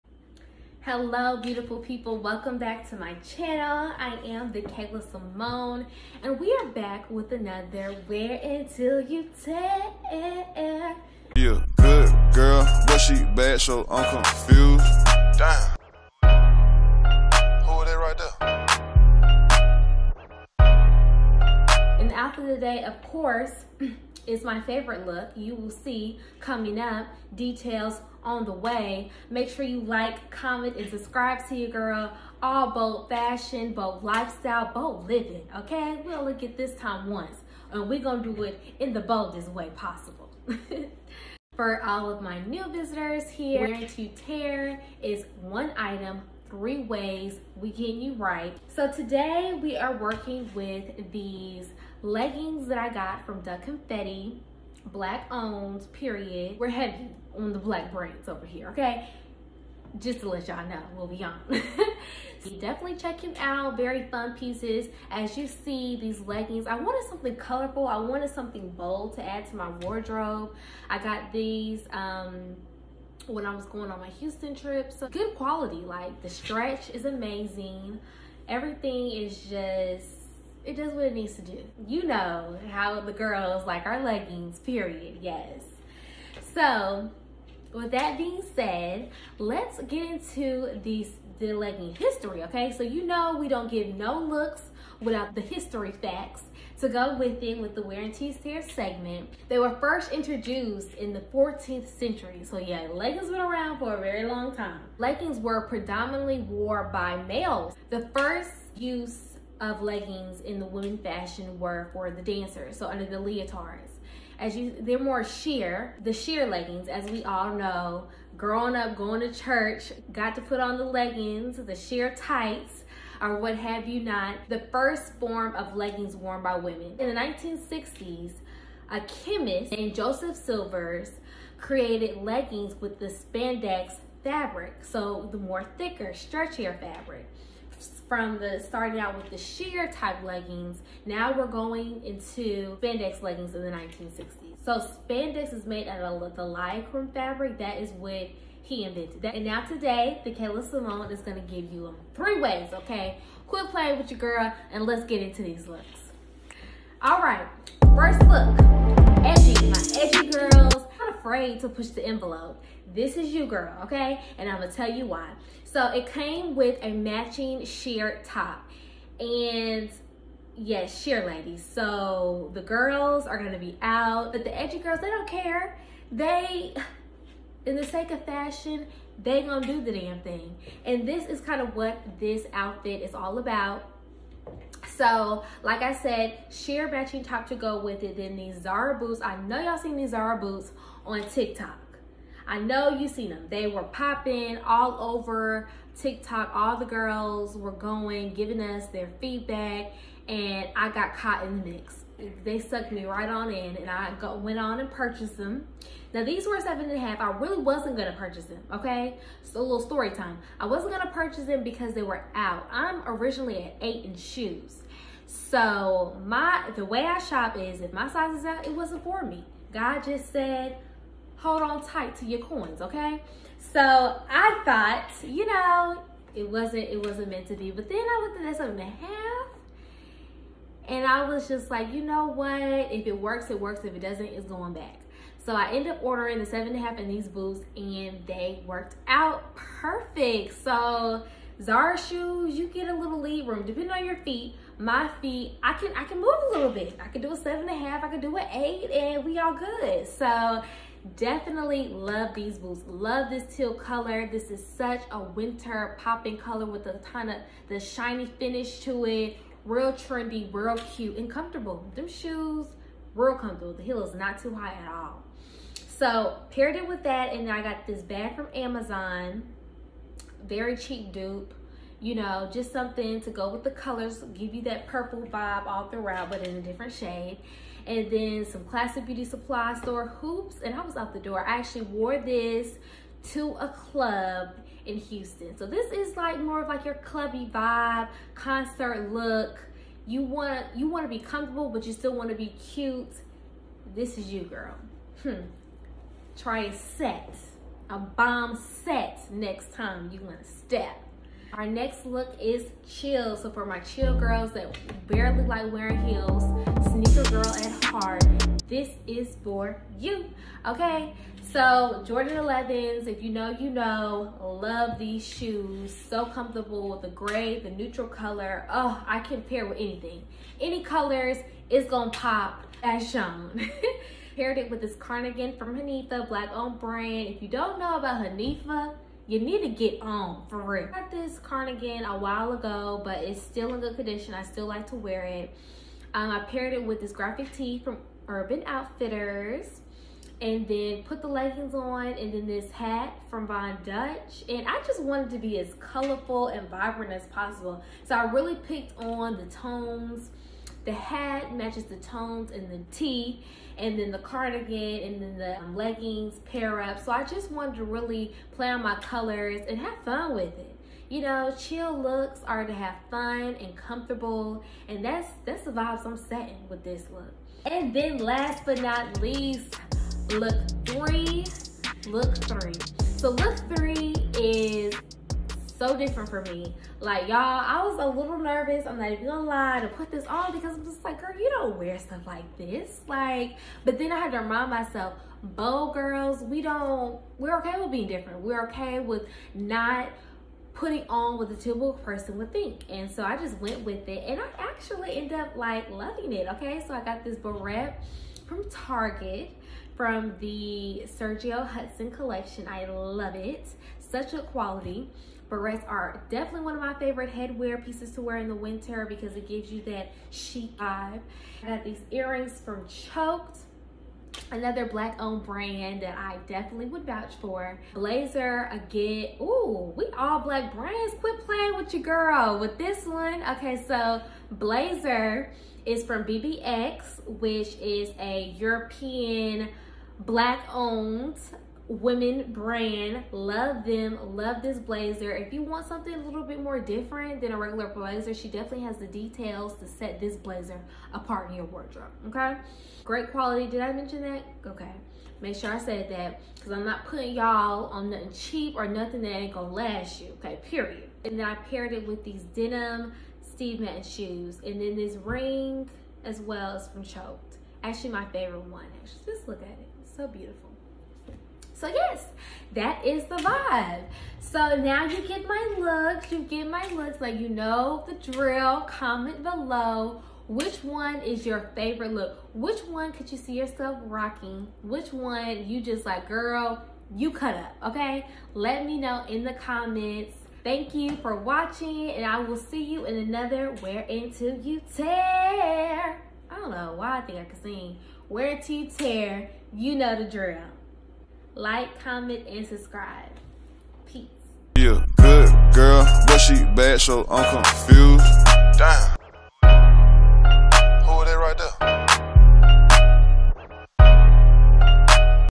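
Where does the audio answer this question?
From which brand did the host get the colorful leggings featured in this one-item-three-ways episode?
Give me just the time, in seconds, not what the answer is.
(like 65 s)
53 s.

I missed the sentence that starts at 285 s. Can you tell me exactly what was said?
So this is like more of like your clubby vibe, concert look.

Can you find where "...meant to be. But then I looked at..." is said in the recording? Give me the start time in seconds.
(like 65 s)
227 s.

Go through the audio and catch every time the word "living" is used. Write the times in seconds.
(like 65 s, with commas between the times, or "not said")
35 s.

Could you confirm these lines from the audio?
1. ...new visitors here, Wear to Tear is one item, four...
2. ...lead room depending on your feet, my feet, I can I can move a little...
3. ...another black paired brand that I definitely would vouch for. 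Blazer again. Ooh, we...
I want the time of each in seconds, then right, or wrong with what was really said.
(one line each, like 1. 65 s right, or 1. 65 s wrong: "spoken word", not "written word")
1. 42 s wrong: "three", not "four"
2. 243 s right
3. 414 s wrong: "owned", not "paired".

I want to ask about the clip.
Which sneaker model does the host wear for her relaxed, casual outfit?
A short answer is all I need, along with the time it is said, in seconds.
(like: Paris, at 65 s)
Jordan 11s, at 312 s.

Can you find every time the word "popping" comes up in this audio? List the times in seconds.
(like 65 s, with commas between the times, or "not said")
193 s, 256 s.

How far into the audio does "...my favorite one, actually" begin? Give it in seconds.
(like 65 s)
458 s.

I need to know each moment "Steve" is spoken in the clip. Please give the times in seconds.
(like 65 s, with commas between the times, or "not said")
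453 s.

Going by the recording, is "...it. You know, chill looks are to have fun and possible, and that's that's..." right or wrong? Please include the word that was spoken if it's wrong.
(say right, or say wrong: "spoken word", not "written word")
wrong: "comfortable", not "possible".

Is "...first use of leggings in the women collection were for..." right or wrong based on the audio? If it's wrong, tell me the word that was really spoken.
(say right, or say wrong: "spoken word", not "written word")
wrong: "fashion", not "collection".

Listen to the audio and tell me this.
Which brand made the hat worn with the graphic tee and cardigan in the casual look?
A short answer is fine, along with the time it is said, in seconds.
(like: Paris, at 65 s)
Von Dutch, at 343 s.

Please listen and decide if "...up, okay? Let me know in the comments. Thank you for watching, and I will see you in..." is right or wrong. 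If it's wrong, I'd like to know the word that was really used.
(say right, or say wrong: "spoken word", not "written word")
right.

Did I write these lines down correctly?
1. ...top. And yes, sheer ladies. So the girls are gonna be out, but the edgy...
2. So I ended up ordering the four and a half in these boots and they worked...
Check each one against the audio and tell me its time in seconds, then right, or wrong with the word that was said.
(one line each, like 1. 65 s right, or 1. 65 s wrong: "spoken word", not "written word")
1. 168 s right
2. 235 s wrong: "seven", not "four".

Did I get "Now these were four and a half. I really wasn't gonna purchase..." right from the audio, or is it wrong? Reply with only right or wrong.
wrong.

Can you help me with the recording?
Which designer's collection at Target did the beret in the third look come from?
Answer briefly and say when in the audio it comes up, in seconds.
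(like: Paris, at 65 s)
Sergio Hudson, at 401 s.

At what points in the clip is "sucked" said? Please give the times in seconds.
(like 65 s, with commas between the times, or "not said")
202 s.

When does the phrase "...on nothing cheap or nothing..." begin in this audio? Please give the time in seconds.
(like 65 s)
447 s.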